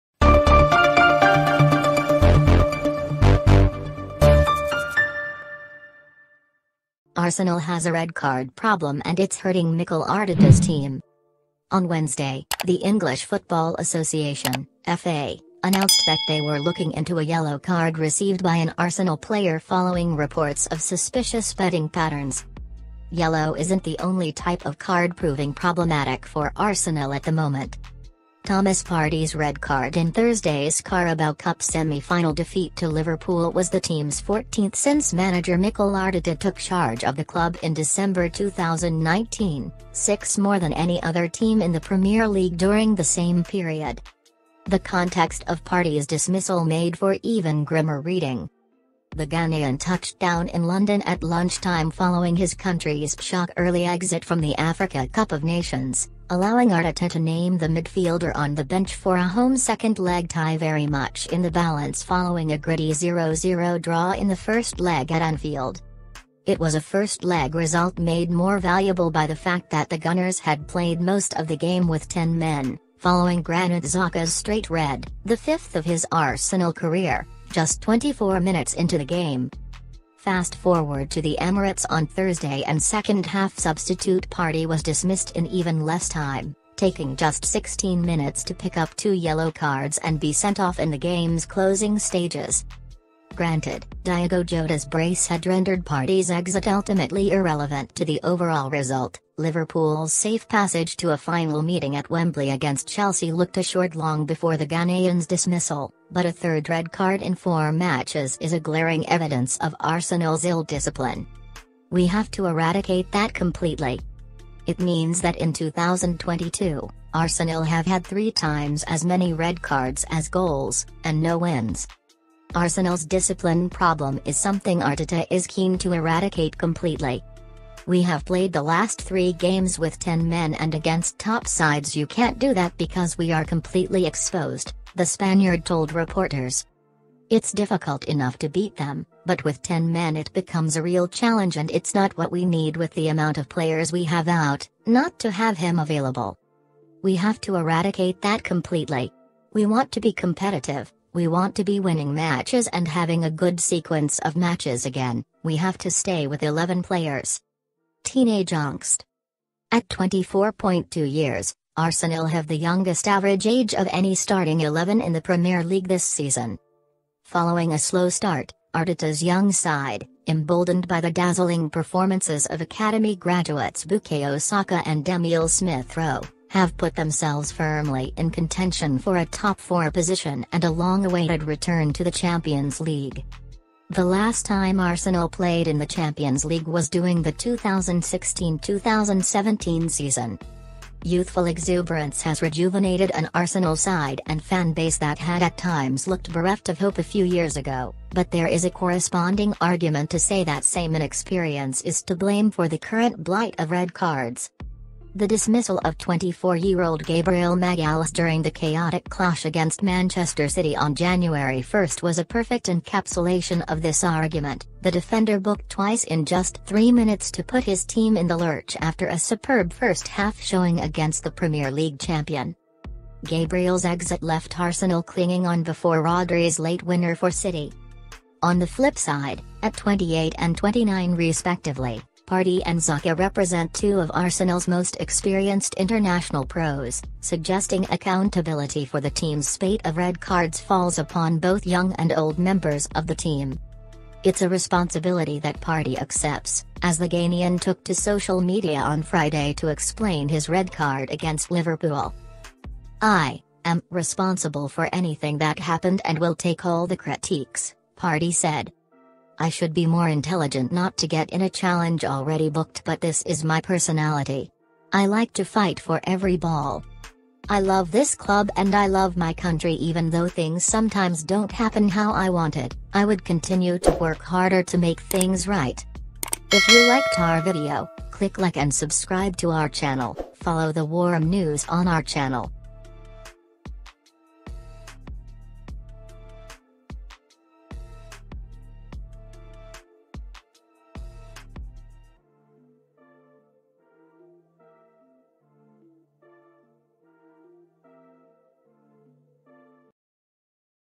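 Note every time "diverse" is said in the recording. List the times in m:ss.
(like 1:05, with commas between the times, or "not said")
not said.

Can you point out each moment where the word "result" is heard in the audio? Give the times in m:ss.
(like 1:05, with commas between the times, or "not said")
1:07, 1:38.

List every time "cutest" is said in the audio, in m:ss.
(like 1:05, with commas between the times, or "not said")
not said.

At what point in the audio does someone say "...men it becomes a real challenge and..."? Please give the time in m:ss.
2:19.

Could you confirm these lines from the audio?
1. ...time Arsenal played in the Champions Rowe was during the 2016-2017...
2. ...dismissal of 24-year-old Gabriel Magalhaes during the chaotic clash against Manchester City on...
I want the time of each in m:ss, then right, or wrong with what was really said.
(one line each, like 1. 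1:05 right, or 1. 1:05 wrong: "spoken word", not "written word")
1. 3:04 wrong: "League", not "Rowe"
2. 3:25 right.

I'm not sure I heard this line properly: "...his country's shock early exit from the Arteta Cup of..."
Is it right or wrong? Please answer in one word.
wrong.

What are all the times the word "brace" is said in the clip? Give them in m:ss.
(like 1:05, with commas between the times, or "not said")
1:34.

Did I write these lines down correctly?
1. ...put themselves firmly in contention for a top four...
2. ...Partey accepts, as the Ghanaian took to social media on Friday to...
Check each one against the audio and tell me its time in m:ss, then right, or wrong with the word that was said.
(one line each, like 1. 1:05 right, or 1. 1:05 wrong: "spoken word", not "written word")
1. 2:56 right
2. 4:05 right.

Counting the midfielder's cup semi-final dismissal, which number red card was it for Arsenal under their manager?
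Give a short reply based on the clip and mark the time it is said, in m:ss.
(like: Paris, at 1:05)
14th, at 0:34.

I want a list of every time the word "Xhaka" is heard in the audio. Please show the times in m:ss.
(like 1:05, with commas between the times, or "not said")
1:13, 3:52.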